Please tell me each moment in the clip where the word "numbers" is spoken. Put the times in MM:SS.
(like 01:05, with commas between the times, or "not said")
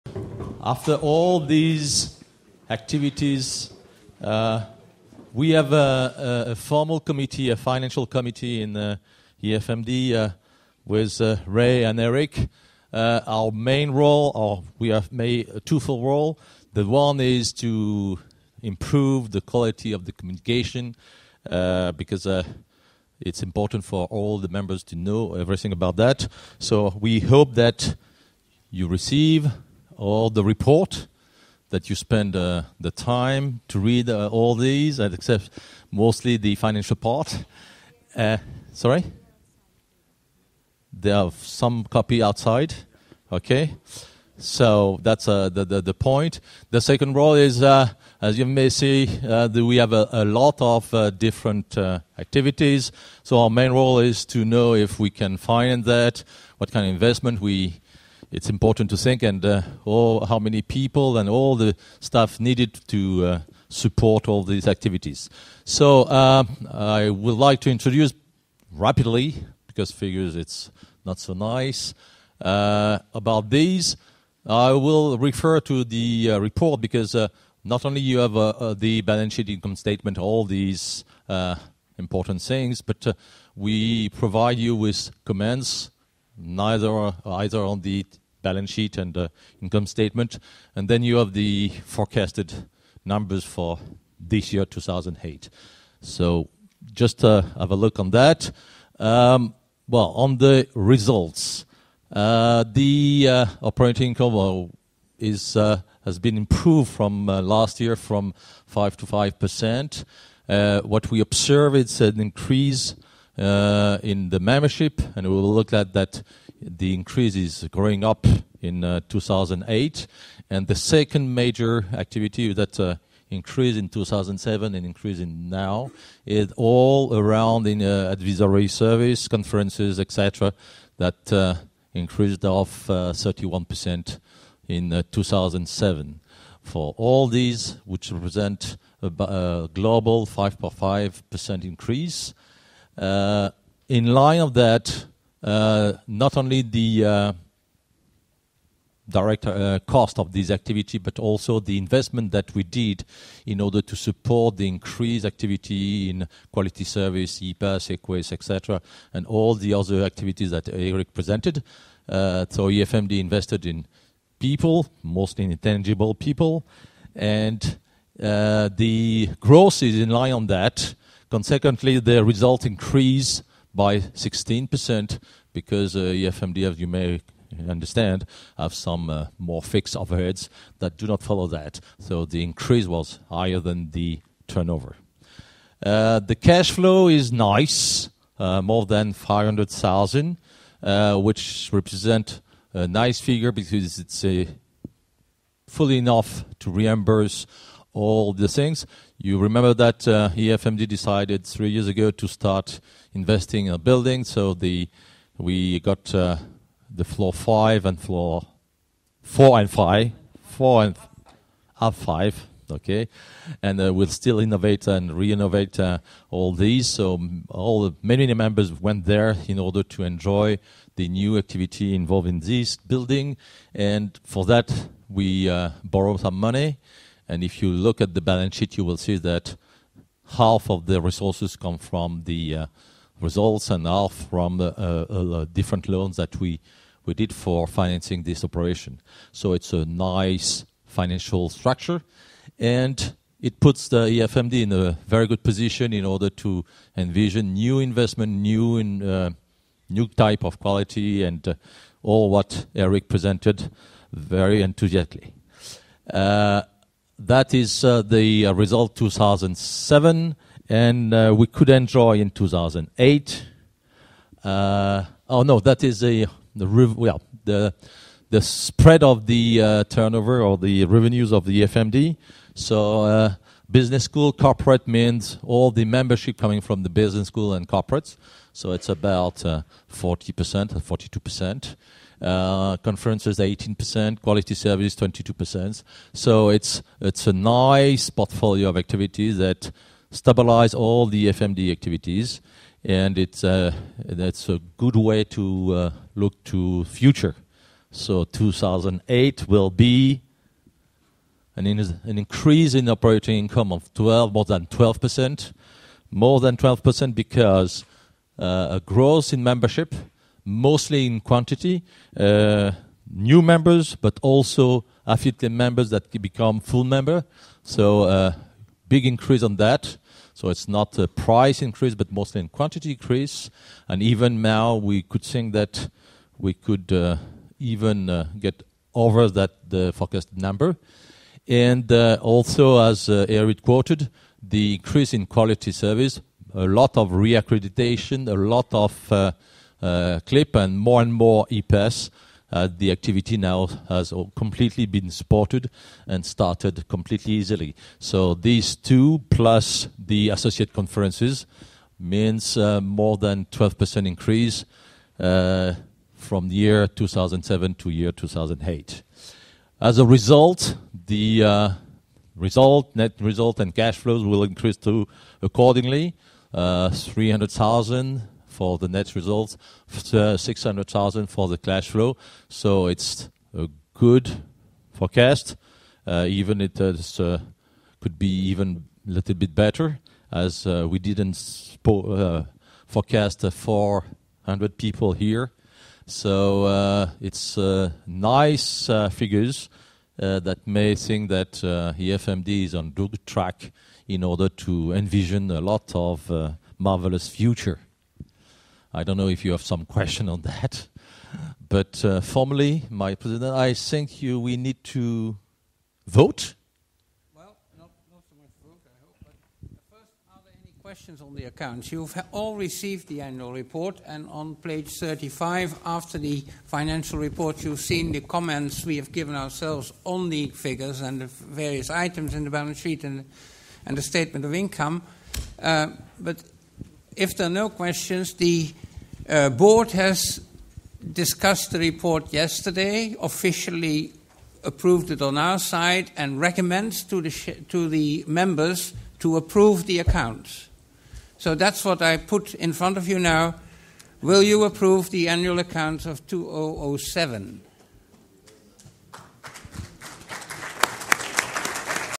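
01:33, 05:30.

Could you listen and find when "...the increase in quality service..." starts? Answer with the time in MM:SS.
05:34.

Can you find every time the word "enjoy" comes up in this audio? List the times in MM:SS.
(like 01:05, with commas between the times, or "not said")
03:40, 04:21.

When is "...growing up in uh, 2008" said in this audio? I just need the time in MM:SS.
01:57.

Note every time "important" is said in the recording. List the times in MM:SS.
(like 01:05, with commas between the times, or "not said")
00:23, 00:58, 01:22.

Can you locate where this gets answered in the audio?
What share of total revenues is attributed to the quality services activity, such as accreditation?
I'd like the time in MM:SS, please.
04:44.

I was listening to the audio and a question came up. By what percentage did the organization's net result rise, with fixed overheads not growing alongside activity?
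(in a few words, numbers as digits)
16%.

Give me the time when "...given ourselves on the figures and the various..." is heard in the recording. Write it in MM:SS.
06:59.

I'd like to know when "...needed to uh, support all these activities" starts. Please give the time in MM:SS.
01:02.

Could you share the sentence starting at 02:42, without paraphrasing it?
So EFMD invested in people, mostly intangible people, and the growth is in line on that.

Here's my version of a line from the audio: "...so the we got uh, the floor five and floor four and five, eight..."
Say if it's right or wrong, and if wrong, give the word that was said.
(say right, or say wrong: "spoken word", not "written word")
wrong: "four", not "eight".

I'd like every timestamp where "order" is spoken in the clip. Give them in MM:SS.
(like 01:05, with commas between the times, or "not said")
02:33, 03:39, 04:06, 06:34.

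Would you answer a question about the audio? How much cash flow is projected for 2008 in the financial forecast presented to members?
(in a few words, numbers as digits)
600,000.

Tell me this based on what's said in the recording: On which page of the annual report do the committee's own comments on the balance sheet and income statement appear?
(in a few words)
35.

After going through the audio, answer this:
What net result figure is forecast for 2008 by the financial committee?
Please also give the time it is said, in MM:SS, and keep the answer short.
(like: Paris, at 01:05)
300,000, at 06:06.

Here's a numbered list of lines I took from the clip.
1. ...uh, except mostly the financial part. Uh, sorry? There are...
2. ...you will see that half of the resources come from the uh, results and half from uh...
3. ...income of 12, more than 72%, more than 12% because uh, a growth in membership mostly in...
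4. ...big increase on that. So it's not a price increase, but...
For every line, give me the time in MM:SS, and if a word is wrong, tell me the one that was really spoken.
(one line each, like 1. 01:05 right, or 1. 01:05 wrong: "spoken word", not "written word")
1. 00:34 right
2. 03:48 right
3. 05:03 wrong: "12", not "72"
4. 05:18 right.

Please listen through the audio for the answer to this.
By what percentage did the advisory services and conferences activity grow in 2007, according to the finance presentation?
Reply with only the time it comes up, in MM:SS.
02:12.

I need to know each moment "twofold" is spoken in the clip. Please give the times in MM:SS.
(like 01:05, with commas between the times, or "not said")
00:15.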